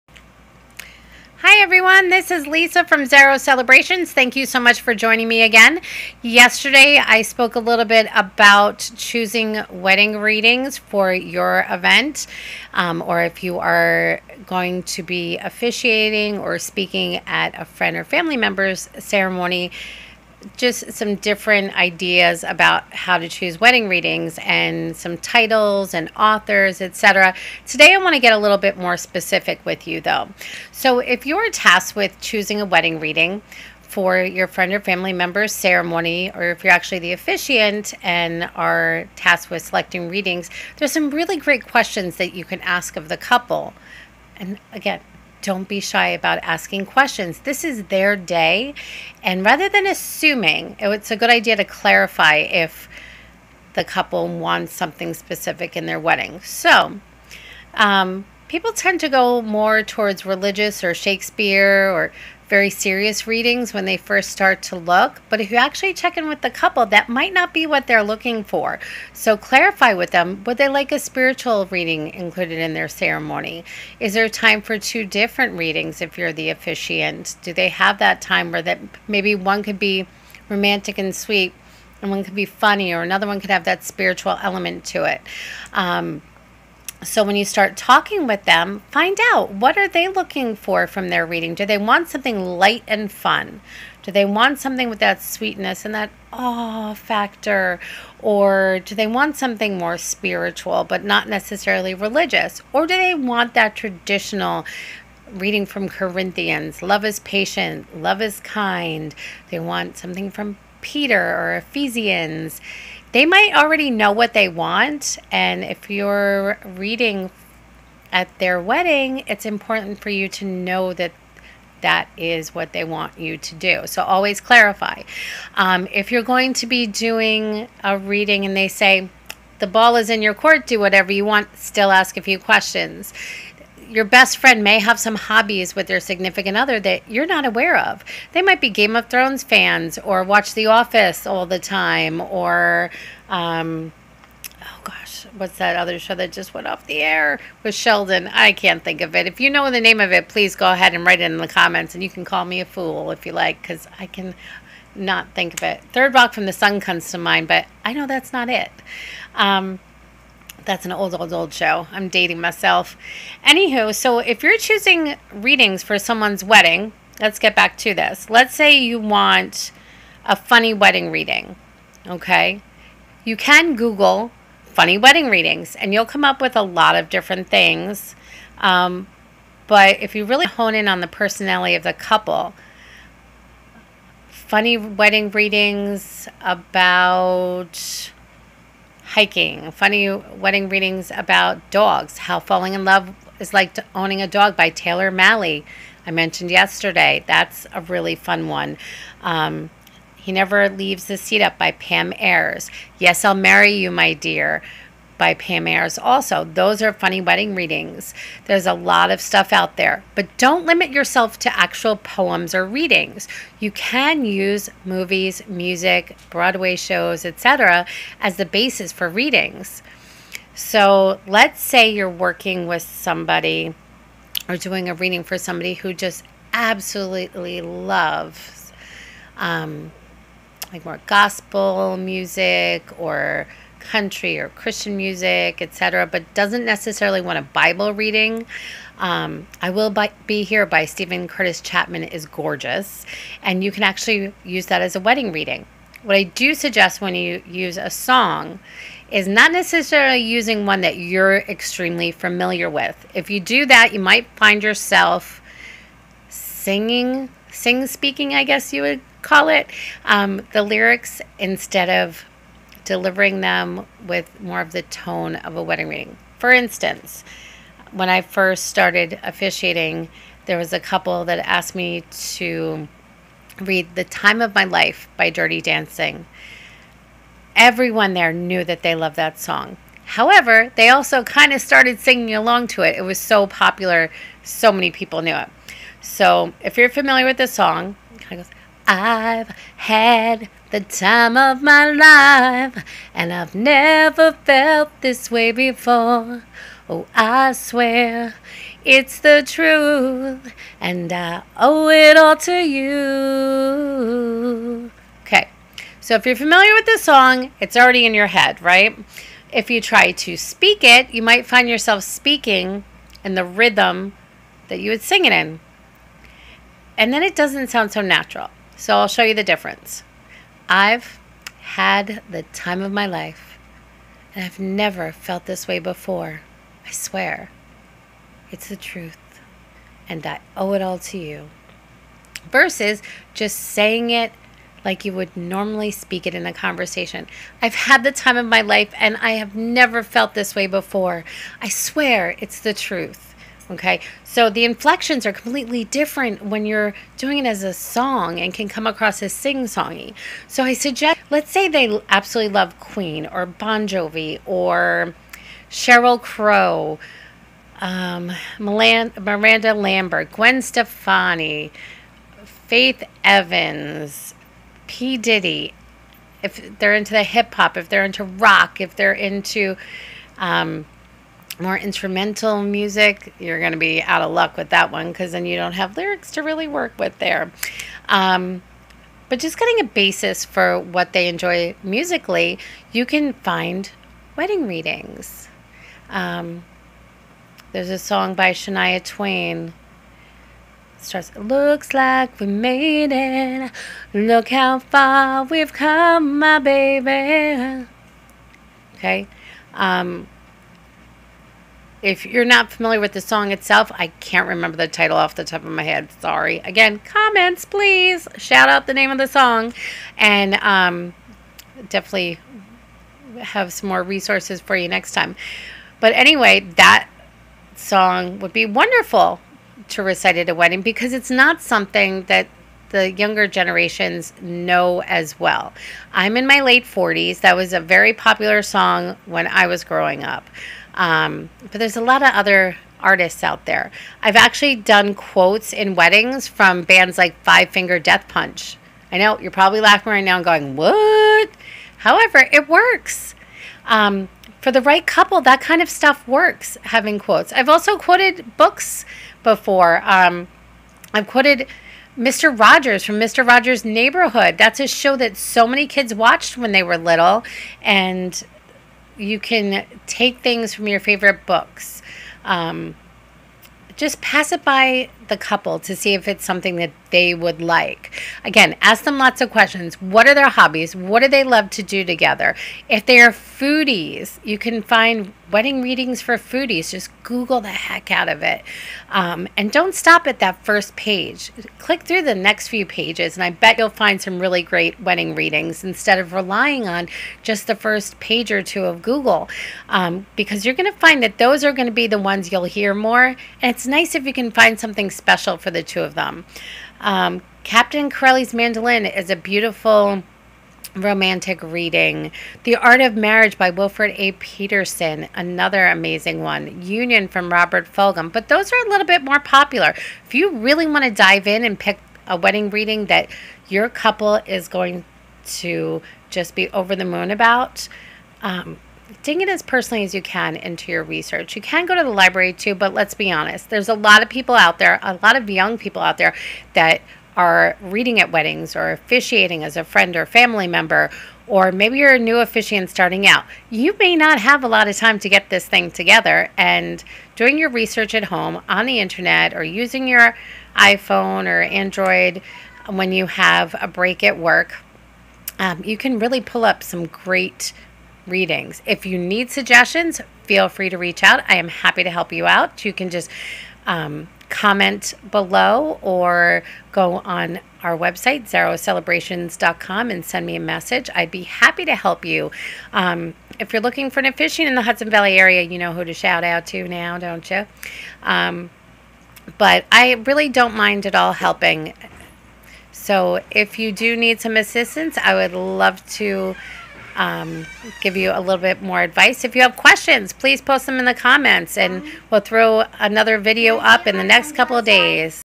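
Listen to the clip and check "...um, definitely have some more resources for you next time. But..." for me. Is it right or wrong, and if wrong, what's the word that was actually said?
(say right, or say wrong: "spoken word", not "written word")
right.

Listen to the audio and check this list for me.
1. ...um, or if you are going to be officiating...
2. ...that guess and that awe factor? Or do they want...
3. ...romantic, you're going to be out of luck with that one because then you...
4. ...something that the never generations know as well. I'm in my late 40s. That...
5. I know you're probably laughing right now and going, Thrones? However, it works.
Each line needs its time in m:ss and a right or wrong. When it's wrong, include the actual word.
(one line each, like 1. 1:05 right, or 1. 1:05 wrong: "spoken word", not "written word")
1. 0:12 right
2. 1:34 wrong: "sweetness", not "guess"
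3. 6:12 wrong: "music", not "romantic"
4. 7:01 wrong: "younger", not "never"
5. 7:19 wrong: "What", not "Thrones".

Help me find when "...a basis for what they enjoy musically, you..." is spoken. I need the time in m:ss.
6:19.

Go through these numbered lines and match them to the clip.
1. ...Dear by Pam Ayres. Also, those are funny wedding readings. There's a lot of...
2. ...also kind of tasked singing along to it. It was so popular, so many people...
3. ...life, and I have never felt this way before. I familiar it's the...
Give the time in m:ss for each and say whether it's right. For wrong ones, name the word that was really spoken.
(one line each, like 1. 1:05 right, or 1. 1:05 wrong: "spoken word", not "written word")
1. 3:24 right
2. 4:40 wrong: "started", not "tasked"
3. 5:38 wrong: "swear", not "familiar".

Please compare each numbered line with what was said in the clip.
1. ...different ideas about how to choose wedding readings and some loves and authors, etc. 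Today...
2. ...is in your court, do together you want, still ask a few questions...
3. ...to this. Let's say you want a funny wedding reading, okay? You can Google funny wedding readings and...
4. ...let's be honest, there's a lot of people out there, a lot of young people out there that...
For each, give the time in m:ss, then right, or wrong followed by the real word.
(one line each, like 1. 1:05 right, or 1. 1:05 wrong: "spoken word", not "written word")
1. 0:21 wrong: "titles", not "loves"
2. 2:09 wrong: "whatever", not "together"
3. 2:47 right
4. 8:42 right.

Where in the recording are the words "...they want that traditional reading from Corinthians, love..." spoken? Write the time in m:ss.
1:42.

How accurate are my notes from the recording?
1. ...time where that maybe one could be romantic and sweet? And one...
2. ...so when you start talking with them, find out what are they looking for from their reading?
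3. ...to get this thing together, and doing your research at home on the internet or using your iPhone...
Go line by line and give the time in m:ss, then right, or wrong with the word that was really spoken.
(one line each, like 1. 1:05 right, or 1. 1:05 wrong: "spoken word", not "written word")
1. 1:18 right
2. 1:27 right
3. 8:55 right.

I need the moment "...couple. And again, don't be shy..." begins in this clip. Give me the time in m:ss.
0:43.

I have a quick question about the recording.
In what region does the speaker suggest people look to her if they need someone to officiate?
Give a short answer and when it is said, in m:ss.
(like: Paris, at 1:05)
Hudson Valley, at 9:24.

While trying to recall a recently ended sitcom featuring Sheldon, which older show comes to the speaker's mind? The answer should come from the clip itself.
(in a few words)
Third Rock from the Sun.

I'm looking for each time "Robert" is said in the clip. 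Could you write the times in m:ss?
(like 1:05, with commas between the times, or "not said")
8:27.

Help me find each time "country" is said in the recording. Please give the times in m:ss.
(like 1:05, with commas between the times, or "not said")
3:53.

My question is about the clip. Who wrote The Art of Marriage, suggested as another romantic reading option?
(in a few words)
Wilferd A. Peterson.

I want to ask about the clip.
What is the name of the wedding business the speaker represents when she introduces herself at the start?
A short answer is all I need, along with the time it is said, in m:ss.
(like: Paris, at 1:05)
Zaro Celebrations, at 0:03.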